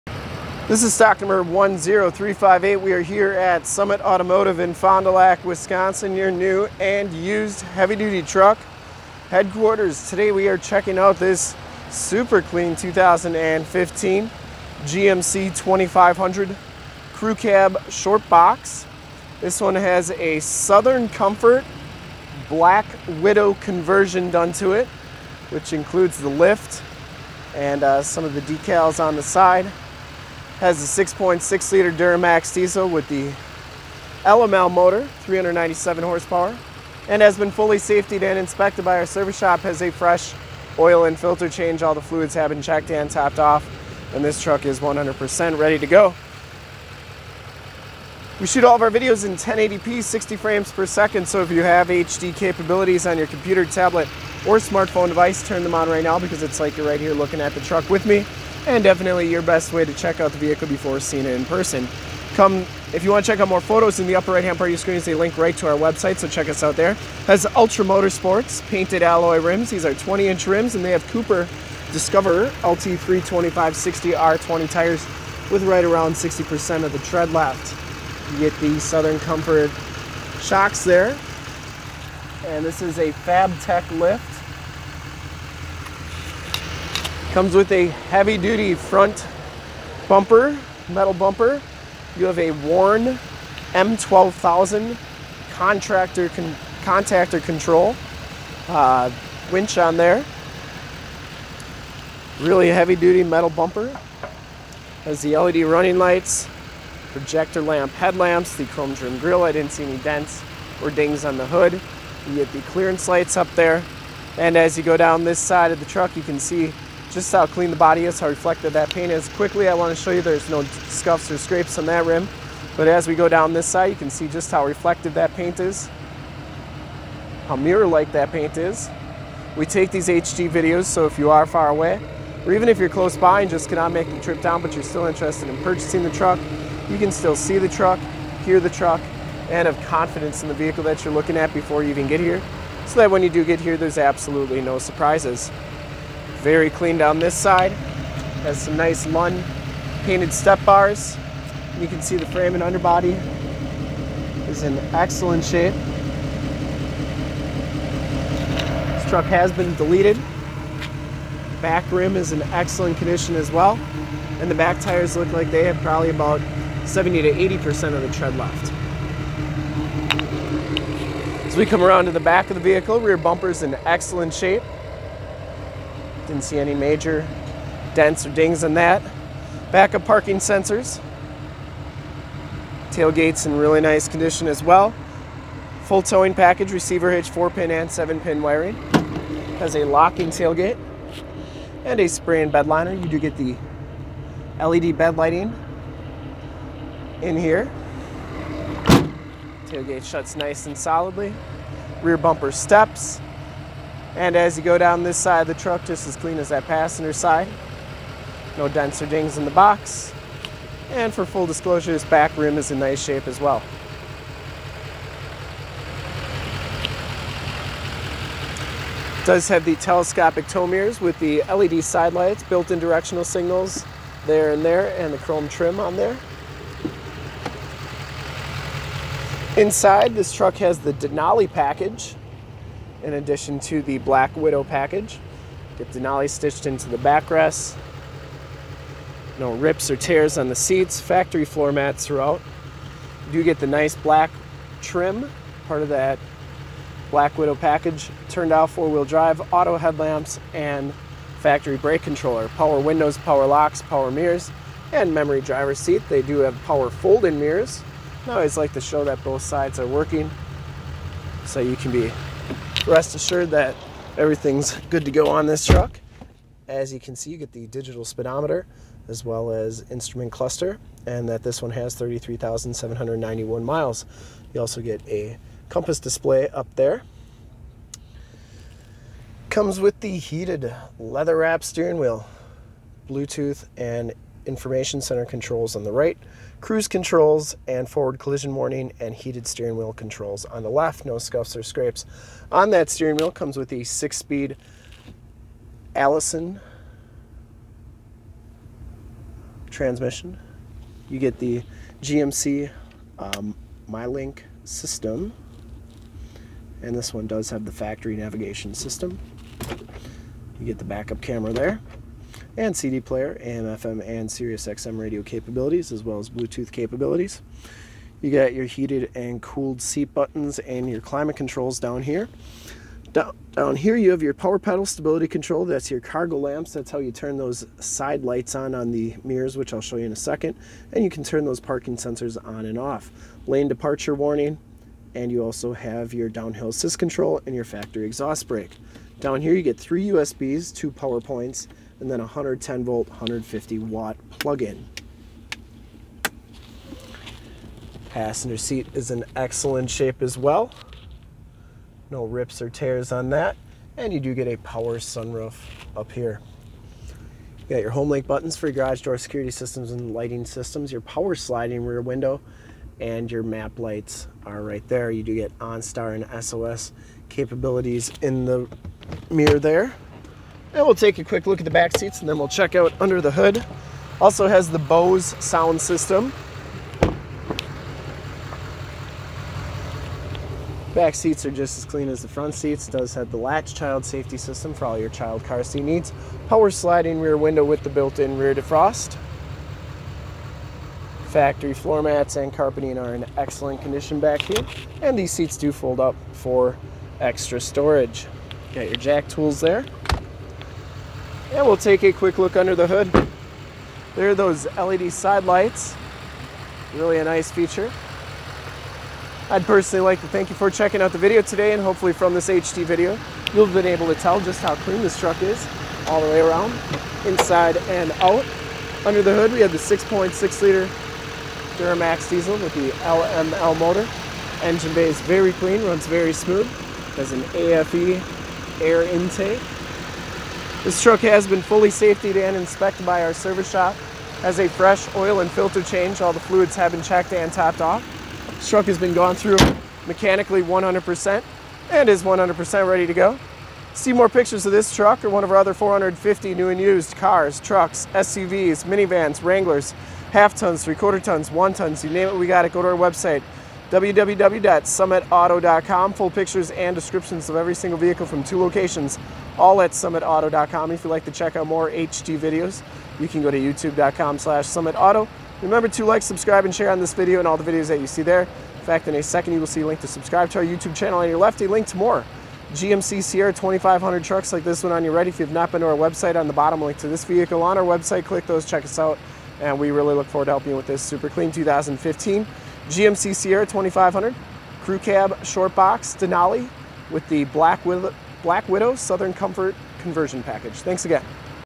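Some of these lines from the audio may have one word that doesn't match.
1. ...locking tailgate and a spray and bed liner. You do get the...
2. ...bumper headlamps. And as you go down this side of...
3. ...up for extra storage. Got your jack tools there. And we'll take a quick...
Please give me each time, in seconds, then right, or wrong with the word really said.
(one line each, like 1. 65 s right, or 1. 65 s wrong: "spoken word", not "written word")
1. 189 s right
2. 202 s wrong: "steps", not "headlamps"
3. 396 s right.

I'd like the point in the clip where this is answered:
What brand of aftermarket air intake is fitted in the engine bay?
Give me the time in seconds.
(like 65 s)
427 s.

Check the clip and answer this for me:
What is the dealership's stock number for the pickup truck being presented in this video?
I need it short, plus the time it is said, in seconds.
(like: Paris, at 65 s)
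10358, at 1 s.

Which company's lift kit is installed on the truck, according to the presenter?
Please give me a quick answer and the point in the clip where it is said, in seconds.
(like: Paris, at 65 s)
Fabtech, at 83 s.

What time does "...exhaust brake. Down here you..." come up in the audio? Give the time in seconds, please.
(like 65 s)
338 s.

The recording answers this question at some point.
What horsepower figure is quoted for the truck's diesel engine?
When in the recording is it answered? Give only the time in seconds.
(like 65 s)
35 s.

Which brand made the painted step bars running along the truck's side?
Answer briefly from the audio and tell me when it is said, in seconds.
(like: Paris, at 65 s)
Lund, at 149 s.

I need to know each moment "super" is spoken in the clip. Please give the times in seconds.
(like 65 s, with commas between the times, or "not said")
11 s, 481 s.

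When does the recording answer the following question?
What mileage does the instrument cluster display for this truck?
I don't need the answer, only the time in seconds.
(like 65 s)
271 s.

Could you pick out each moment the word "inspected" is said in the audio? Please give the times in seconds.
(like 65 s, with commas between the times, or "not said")
38 s, 432 s.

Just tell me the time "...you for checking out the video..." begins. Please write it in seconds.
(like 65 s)
410 s.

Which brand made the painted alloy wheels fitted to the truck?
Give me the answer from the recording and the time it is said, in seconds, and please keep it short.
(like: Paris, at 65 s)
Ultra Motorsports, at 67 s.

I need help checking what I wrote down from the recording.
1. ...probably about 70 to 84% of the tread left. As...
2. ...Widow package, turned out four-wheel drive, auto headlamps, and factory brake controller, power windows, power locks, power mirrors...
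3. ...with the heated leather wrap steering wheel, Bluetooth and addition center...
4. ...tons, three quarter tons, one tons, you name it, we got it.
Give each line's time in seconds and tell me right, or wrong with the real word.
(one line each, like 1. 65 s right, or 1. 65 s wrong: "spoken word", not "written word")
1. 165 s wrong: "80", not "84"
2. 247 s right
3. 279 s wrong: "information", not "addition"
4. 450 s right.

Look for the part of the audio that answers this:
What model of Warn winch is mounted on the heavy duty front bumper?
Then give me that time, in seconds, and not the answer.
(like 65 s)
93 s.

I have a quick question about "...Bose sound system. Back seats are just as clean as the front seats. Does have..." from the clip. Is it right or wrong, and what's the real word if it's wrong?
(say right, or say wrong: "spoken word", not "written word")
right.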